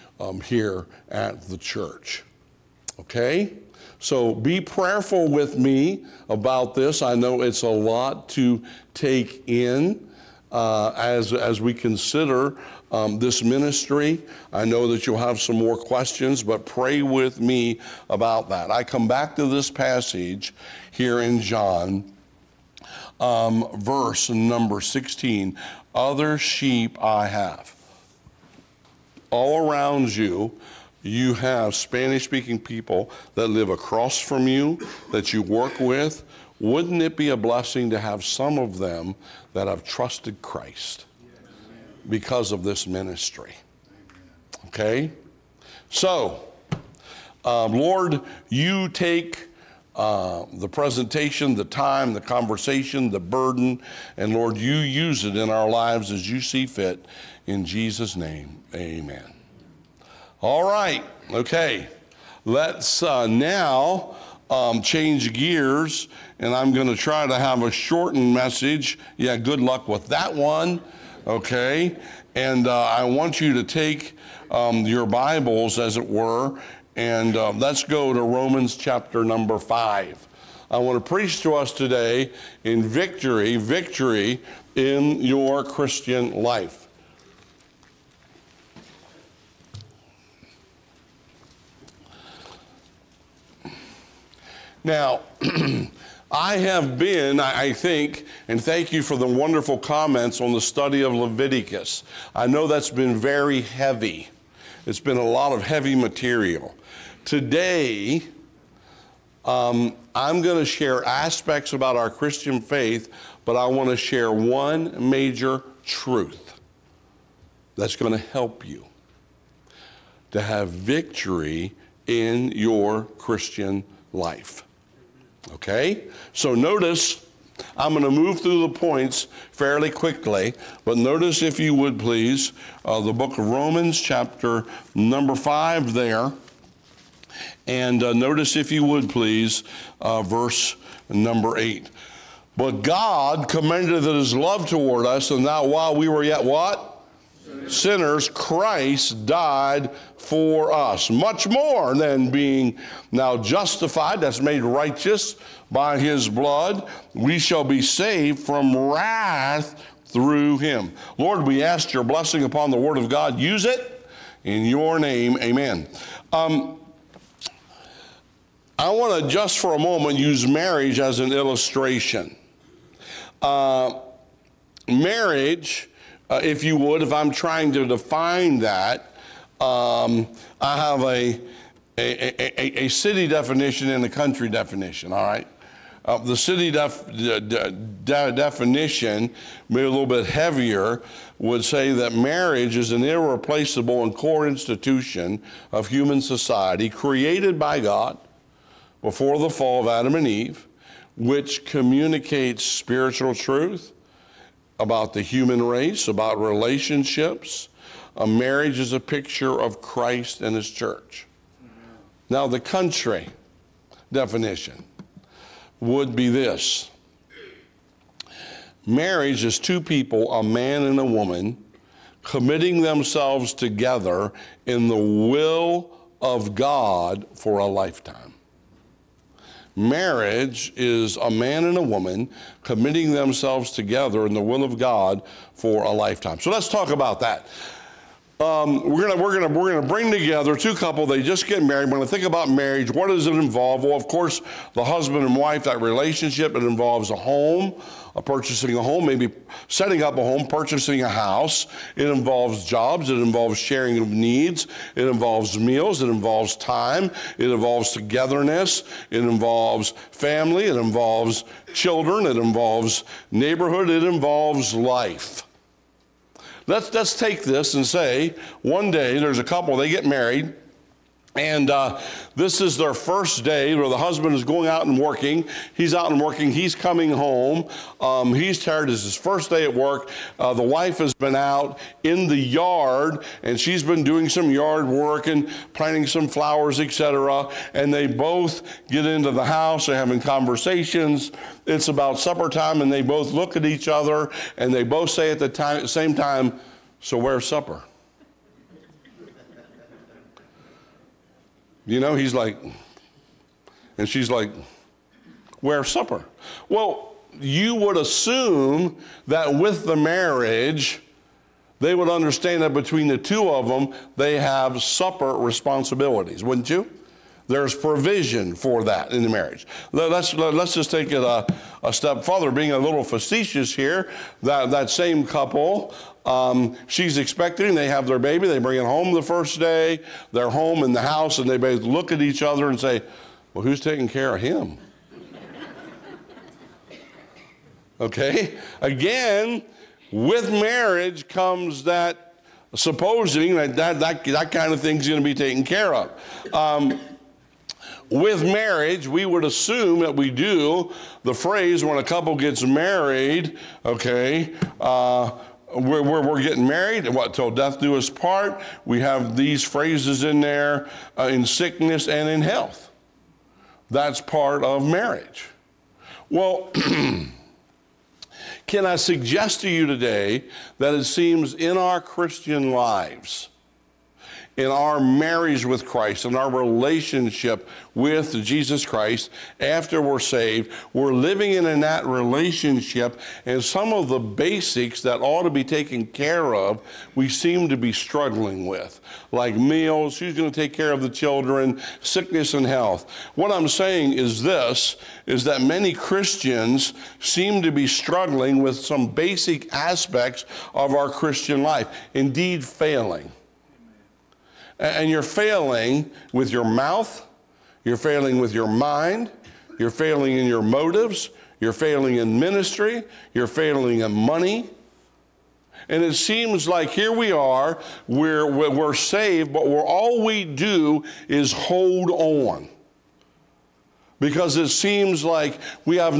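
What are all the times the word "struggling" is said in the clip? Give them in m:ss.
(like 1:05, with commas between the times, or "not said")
6:27, 6:37.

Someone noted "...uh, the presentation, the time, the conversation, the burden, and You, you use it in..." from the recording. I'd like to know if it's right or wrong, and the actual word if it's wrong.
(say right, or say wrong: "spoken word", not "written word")
wrong: "Lord", not "You".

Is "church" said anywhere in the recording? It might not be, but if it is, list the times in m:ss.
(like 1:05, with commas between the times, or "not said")
0:01, 3:30.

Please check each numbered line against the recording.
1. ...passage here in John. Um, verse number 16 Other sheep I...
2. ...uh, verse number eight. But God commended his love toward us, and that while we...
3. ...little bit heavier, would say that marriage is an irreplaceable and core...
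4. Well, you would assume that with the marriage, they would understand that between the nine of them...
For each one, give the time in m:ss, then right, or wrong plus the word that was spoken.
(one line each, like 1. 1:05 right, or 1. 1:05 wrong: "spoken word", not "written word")
1. 0:19 right
2. 2:20 right
3. 3:09 right
4. 5:06 wrong: "two", not "nine".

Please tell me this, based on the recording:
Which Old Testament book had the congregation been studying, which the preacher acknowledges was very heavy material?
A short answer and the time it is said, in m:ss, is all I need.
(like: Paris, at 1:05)
Leviticus, at 1:41.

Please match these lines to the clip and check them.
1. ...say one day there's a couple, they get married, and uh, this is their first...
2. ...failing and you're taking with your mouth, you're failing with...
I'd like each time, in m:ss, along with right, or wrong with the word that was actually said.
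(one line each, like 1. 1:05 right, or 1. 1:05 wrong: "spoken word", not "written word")
1. 4:27 right
2. 6:42 wrong: "failing", not "taking".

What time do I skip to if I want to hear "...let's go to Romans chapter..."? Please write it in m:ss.
1:17.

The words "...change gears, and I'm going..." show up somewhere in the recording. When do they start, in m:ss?
1:04.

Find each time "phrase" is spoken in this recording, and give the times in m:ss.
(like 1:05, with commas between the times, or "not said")
5:51, 5:59.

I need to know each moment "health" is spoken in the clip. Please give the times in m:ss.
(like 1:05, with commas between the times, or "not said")
6:02, 6:32.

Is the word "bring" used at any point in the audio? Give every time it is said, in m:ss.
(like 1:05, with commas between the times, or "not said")
3:59, 5:28.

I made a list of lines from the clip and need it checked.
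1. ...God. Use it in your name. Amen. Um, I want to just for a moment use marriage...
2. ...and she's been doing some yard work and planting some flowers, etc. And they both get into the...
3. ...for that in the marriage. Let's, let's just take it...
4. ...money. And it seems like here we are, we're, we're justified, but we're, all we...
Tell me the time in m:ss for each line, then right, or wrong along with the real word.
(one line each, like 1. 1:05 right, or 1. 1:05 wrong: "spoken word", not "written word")
1. 2:43 right
2. 4:43 right
3. 5:18 right
4. 6:54 wrong: "saved", not "justified".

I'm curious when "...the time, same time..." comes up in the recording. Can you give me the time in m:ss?
4:55.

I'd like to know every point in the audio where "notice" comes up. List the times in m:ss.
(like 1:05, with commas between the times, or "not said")
2:06, 2:10, 2:18.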